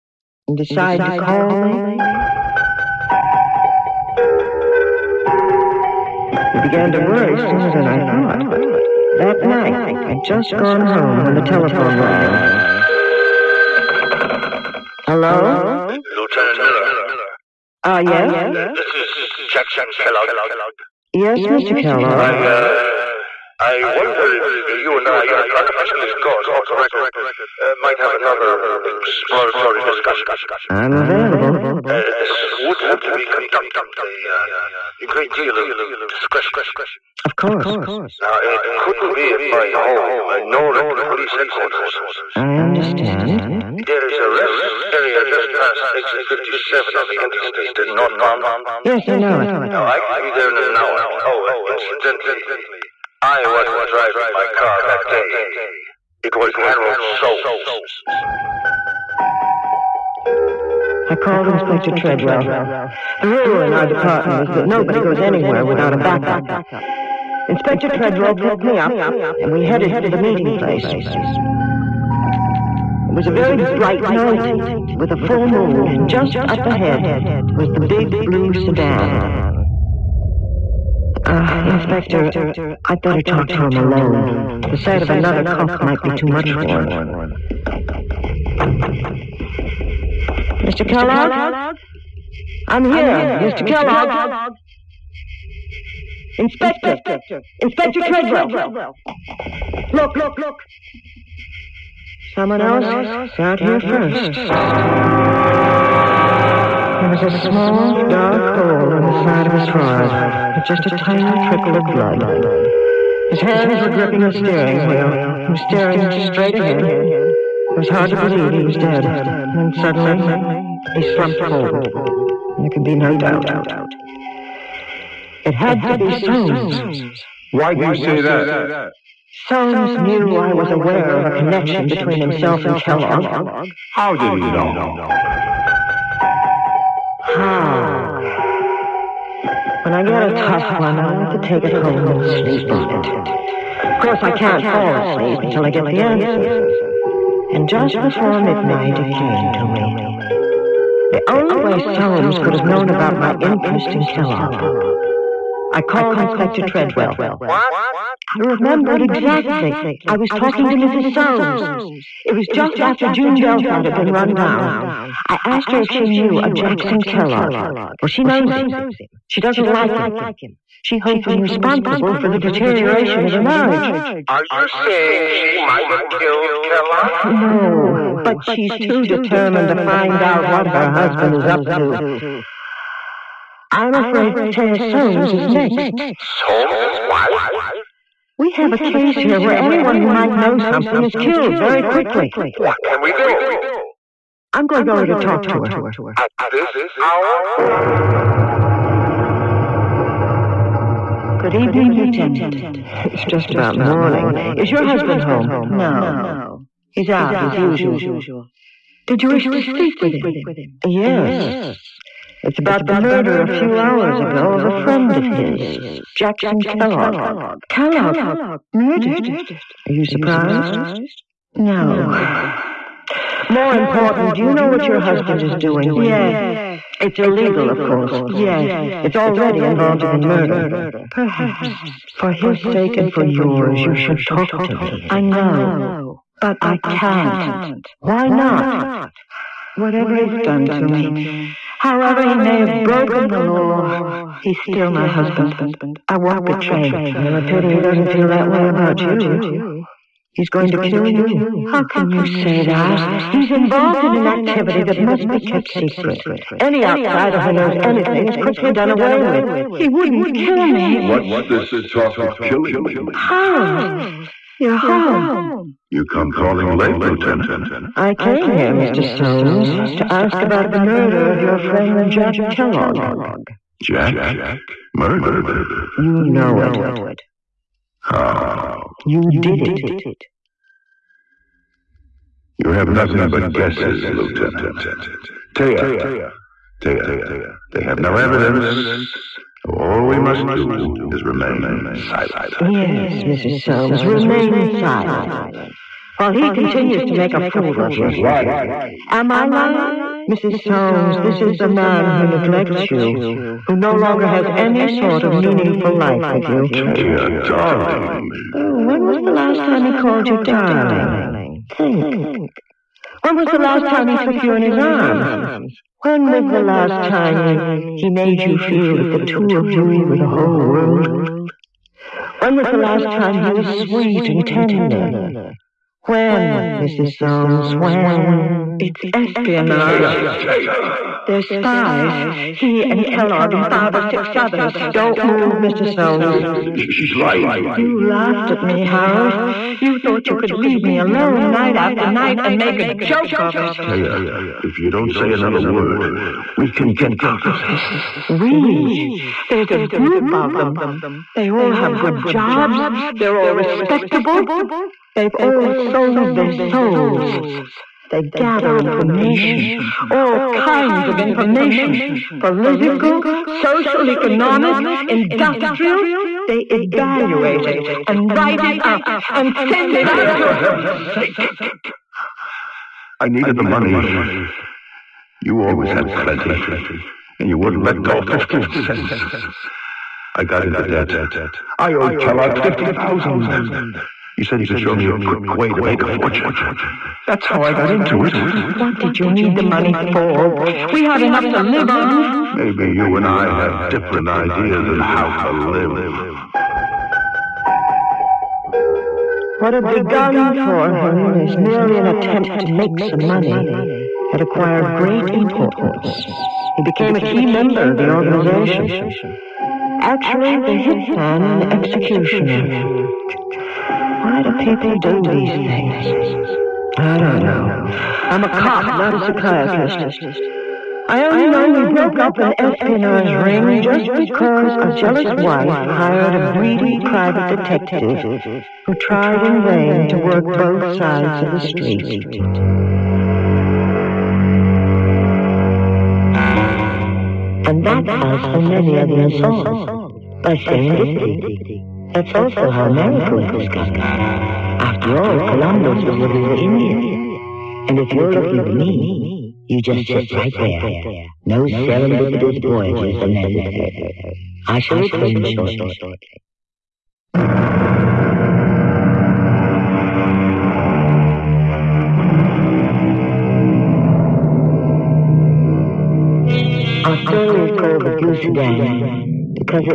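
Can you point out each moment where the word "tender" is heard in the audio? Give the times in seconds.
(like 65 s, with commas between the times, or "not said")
324 s.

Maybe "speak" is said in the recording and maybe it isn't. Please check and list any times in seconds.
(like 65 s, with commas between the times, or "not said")
209 s.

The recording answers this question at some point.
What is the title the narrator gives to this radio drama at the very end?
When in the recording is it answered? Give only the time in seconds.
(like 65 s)
468 s.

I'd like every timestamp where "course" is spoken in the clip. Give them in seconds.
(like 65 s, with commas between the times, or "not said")
26 s, 37 s, 144 s, 227 s.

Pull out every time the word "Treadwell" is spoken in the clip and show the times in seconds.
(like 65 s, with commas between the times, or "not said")
61 s, 67 s, 98 s, 156 s.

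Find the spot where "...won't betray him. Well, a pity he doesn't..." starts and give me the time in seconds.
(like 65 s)
246 s.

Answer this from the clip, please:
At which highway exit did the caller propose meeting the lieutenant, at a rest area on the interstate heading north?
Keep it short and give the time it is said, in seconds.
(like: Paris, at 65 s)
57, at 45 s.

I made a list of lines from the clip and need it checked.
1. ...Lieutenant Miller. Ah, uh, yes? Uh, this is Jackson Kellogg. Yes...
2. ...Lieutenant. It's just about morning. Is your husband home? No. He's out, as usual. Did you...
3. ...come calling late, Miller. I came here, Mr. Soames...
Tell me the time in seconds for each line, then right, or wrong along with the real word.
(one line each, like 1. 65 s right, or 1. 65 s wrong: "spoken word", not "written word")
1. 16 s right
2. 201 s right
3. 266 s wrong: "Lieutenant", not "Miller".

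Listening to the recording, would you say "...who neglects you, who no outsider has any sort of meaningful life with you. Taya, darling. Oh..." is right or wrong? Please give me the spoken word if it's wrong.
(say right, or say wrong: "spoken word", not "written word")
wrong: "longer", not "outsider".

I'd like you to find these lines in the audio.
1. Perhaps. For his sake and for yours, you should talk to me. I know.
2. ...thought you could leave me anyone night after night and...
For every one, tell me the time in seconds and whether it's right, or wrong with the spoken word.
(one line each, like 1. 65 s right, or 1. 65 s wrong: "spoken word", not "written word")
1. 231 s right
2. 340 s wrong: "alone", not "anyone".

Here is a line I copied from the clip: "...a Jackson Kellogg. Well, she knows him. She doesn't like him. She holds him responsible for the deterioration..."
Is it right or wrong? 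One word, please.
right.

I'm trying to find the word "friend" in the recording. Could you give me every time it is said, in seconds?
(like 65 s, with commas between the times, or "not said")
214 s, 271 s.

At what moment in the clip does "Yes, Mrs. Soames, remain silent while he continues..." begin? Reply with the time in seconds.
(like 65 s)
292 s.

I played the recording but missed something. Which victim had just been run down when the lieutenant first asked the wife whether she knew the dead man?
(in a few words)
June Delfat.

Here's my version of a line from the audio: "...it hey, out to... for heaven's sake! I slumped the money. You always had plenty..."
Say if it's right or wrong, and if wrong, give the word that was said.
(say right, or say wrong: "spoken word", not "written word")
wrong: "needed", not "slumped".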